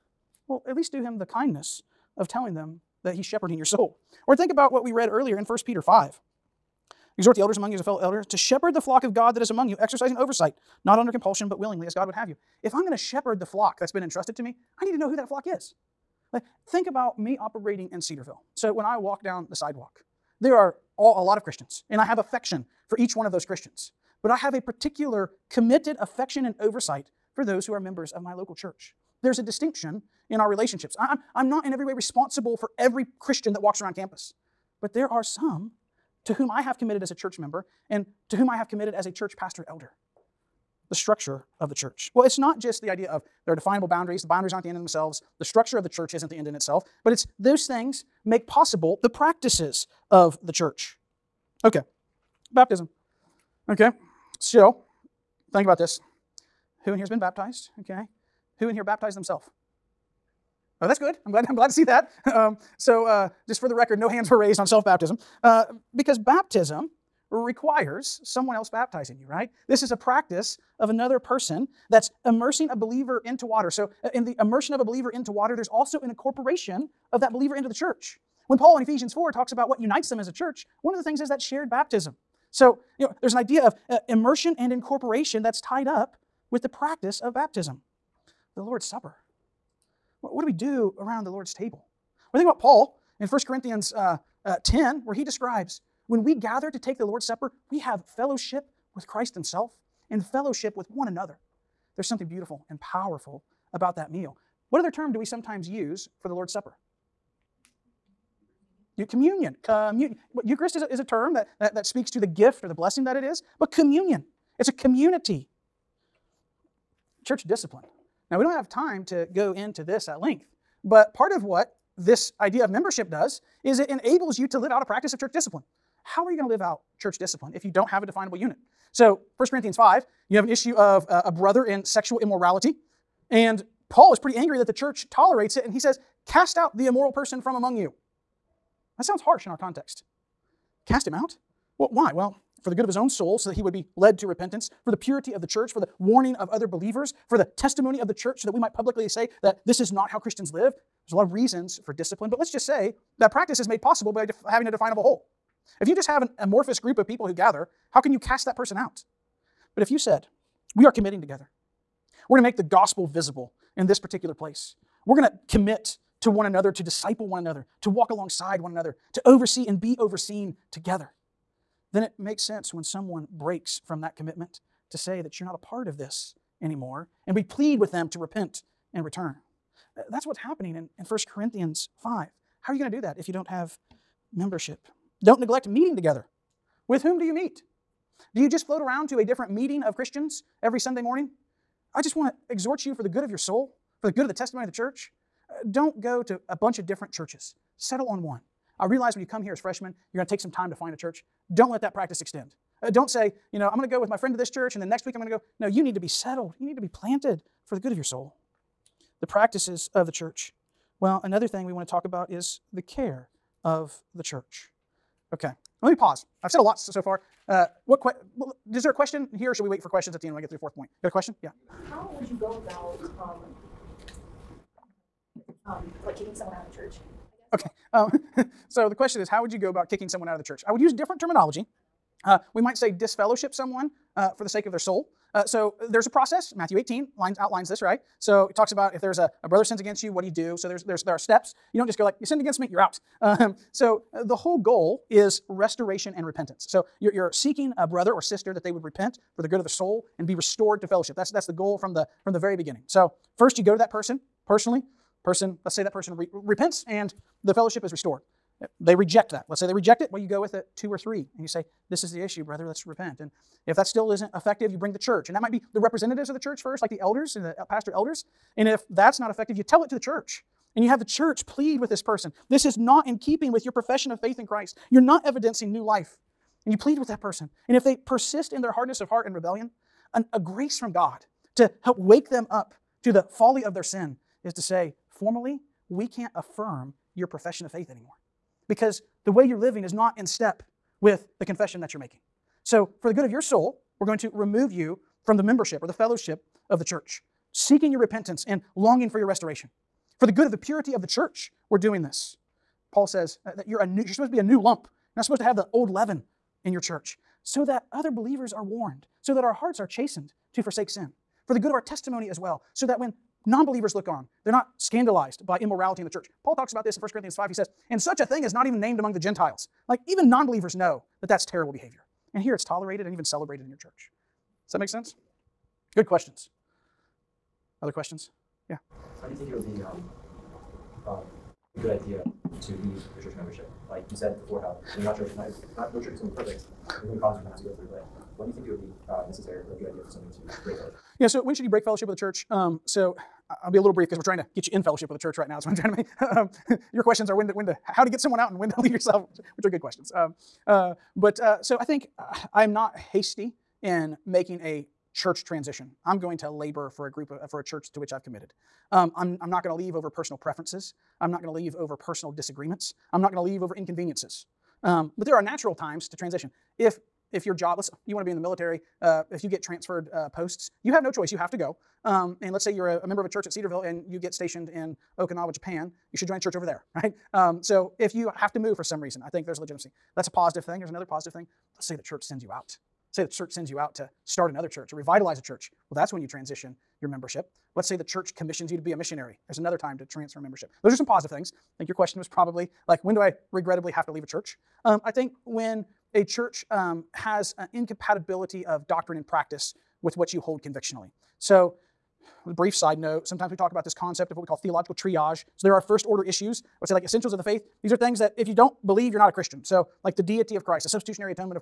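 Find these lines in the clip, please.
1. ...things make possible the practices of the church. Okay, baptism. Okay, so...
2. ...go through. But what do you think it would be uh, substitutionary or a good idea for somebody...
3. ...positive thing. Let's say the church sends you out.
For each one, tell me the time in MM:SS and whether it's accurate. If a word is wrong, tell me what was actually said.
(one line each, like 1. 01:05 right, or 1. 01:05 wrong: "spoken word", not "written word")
1. 00:47 right
2. 05:37 wrong: "necessary", not "substitutionary"
3. 06:21 right.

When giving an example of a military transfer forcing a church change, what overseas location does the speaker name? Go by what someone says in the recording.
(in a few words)
Okinawa, Japan.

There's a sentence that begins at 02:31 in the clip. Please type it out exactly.
There's a lot of reasons for discipline, but let's just say that practice is made possible by def- having a definable whole.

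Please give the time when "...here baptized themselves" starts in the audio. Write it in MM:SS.
00:58.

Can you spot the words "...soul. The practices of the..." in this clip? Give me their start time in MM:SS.
03:28.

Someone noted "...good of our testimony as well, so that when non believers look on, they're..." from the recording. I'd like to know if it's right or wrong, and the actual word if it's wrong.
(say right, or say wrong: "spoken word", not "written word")
right.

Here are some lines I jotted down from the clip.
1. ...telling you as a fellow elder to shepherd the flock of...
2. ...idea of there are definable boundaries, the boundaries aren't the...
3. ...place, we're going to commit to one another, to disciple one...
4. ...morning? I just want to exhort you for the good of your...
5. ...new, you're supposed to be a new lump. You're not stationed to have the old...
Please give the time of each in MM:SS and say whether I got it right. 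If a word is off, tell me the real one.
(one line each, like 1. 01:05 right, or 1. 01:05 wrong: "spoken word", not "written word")
1. 00:07 wrong: "among", not "telling"
2. 00:42 right
3. 02:44 right
4. 03:11 right
5. 05:03 wrong: "supposed", not "stationed".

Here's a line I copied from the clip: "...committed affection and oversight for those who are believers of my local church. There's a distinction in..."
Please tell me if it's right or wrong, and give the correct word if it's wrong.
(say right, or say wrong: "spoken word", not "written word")
wrong: "members", not "believers".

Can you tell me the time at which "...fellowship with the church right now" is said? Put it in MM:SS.
05:44.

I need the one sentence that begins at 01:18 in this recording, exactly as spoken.
When Paul in Ephesians 4 talks about what unites them as a church, one of the things is that shared baptism.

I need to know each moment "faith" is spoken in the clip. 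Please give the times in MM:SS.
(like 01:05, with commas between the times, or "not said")
04:34, 04:47, 06:47.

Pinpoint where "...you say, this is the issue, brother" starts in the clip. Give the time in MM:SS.
04:21.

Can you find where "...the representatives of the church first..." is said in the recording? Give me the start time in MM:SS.
04:25.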